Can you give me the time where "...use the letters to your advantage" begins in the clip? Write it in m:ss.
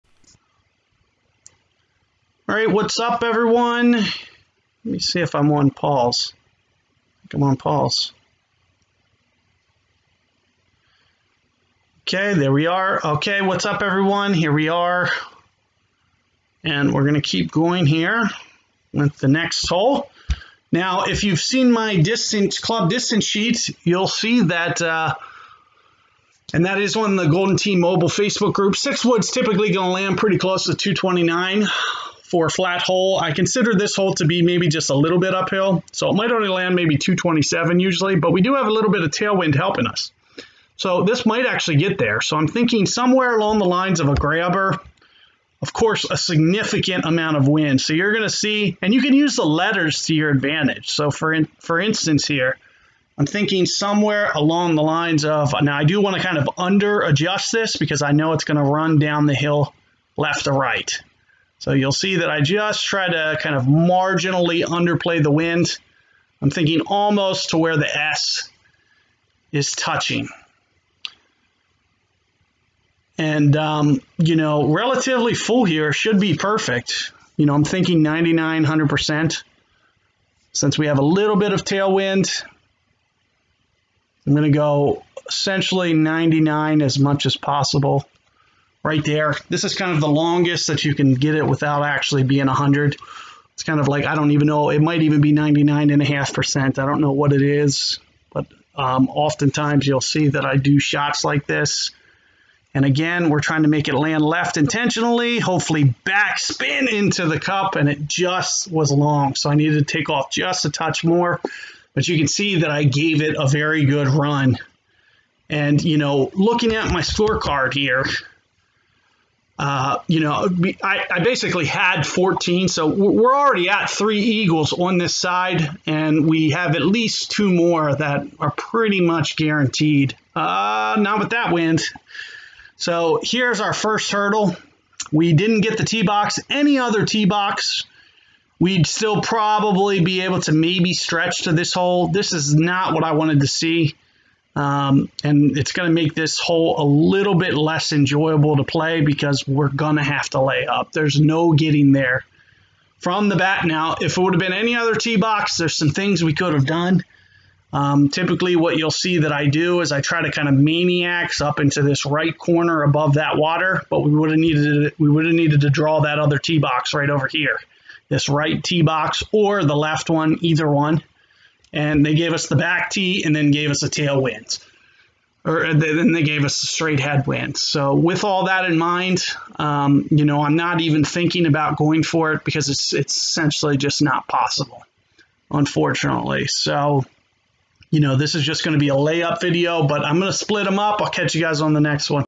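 0:49.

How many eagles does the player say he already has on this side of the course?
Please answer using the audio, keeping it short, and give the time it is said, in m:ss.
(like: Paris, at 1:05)
3, at 2:03.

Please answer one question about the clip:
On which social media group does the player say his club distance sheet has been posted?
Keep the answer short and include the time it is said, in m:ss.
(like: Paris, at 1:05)
Golden Tee Mobile Facebook group, at 0:27.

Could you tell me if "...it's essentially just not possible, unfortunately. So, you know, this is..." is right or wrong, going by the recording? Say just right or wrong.
right.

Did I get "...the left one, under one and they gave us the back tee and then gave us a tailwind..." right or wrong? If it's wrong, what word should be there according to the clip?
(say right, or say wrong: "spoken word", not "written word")
wrong: "either", not "under".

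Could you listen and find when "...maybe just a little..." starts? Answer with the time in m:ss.
0:34.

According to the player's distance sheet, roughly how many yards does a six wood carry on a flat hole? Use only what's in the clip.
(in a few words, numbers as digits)
229.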